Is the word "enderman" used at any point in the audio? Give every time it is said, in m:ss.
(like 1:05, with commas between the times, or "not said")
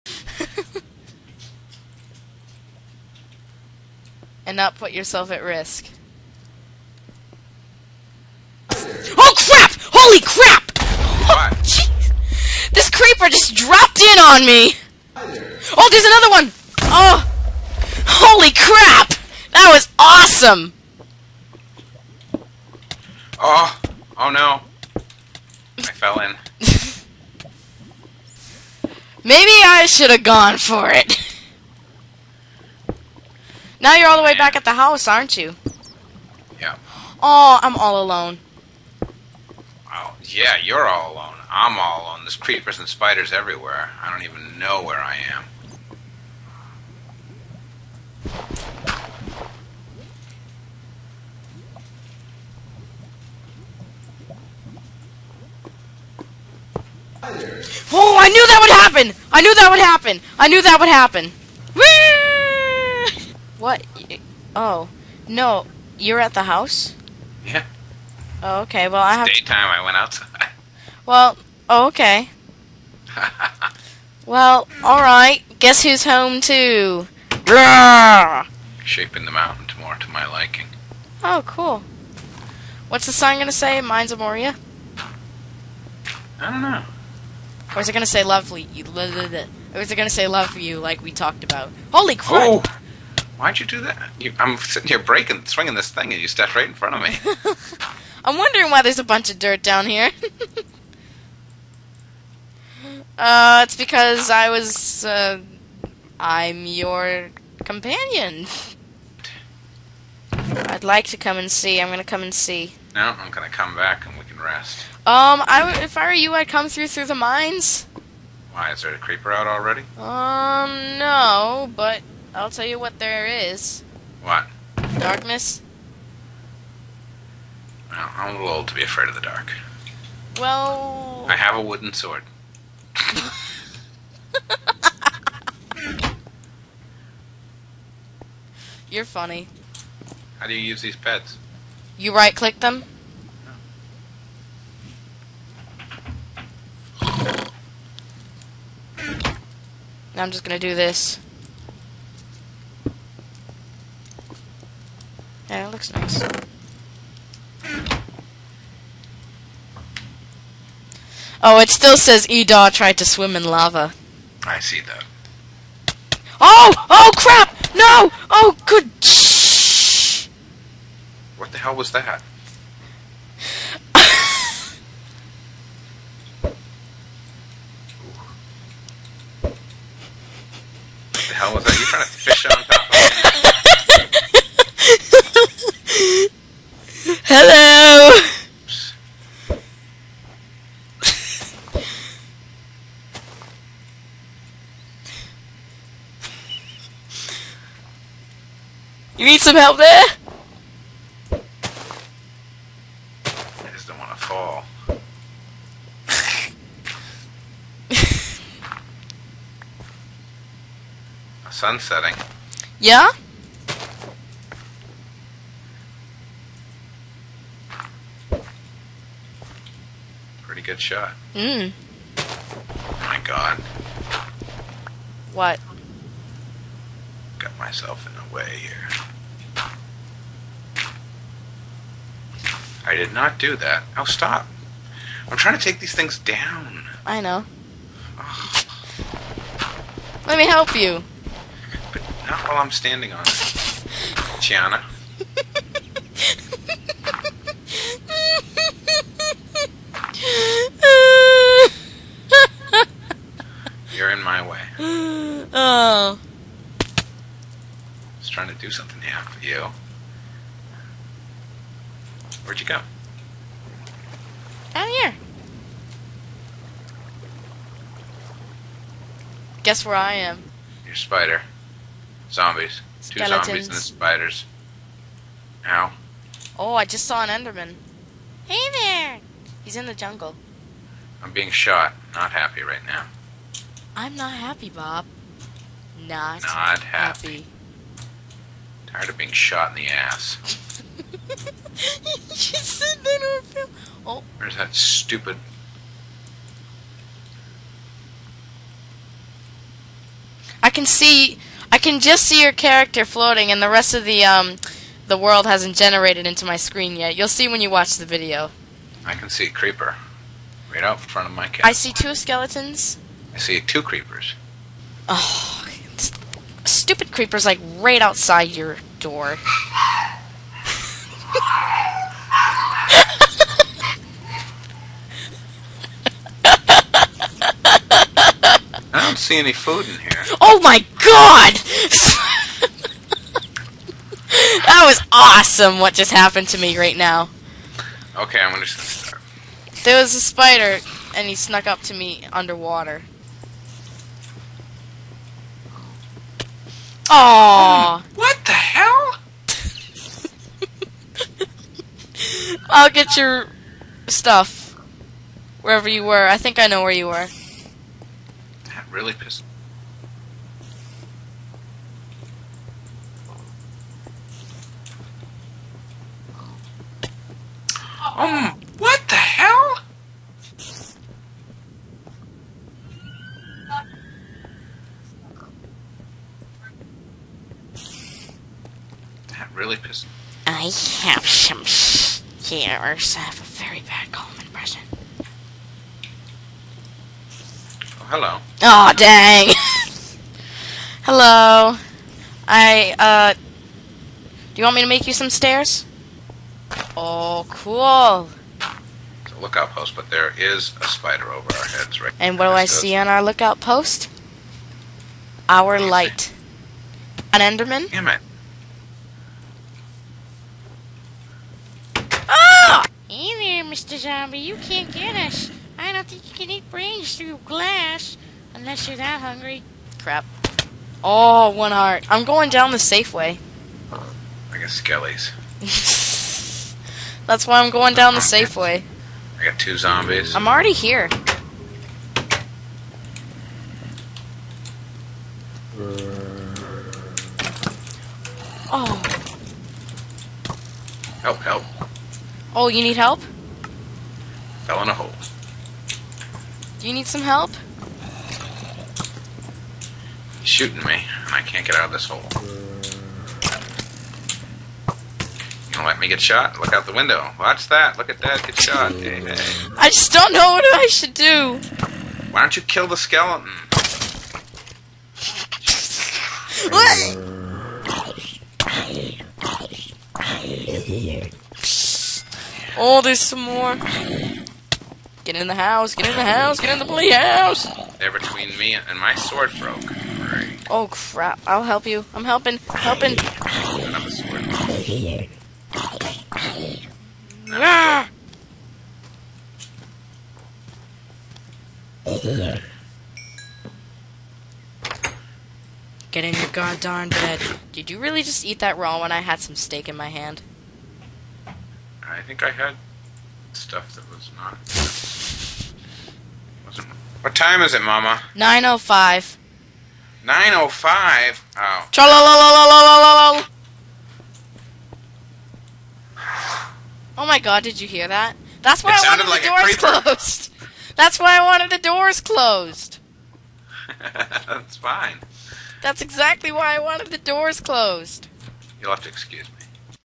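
4:37, 6:47.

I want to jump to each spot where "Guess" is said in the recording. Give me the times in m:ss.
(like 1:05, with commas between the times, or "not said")
1:15, 4:29.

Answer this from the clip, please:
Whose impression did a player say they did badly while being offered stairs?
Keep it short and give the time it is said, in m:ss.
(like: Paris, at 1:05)
Coleman, at 6:24.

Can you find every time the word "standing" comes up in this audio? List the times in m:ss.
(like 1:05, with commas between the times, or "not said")
4:02.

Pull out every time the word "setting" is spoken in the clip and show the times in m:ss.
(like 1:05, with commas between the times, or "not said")
3:31.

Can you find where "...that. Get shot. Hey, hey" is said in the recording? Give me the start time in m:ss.
7:38.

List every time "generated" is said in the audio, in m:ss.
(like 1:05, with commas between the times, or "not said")
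5:05.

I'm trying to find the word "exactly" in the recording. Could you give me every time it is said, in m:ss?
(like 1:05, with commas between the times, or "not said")
8:46.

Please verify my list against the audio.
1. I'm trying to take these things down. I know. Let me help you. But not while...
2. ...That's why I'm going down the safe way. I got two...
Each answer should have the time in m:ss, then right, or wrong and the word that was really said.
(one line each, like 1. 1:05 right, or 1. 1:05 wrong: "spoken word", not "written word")
1. 3:55 right
2. 7:07 right.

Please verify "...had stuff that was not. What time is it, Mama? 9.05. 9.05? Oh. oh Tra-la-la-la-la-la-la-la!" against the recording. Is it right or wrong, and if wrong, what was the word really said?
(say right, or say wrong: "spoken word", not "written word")
right.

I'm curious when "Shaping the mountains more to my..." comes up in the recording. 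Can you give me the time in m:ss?
1:18.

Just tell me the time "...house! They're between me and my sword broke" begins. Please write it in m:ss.
7:57.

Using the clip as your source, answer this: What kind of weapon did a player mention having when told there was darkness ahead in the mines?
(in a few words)
wooden sword.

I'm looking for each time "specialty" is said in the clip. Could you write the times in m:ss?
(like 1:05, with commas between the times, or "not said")
not said.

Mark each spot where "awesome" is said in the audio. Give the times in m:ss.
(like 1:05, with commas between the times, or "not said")
0:19, 5:35.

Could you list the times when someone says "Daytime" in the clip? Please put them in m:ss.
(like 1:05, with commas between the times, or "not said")
1:09.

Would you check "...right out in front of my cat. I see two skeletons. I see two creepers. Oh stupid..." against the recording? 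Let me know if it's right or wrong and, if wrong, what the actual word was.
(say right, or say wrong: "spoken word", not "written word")
right.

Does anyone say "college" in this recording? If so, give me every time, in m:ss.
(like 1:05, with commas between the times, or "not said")
not said.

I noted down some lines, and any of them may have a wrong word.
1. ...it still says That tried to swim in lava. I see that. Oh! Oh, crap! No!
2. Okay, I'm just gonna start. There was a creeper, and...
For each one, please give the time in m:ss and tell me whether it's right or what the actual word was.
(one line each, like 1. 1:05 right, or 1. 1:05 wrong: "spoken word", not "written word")
1. 2:41 wrong: "Edar", not "That"
2. 5:38 wrong: "spider", not "creeper".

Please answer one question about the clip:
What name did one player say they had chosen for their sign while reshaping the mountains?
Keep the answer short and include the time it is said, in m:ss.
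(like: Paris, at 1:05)
Amoria, at 1:24.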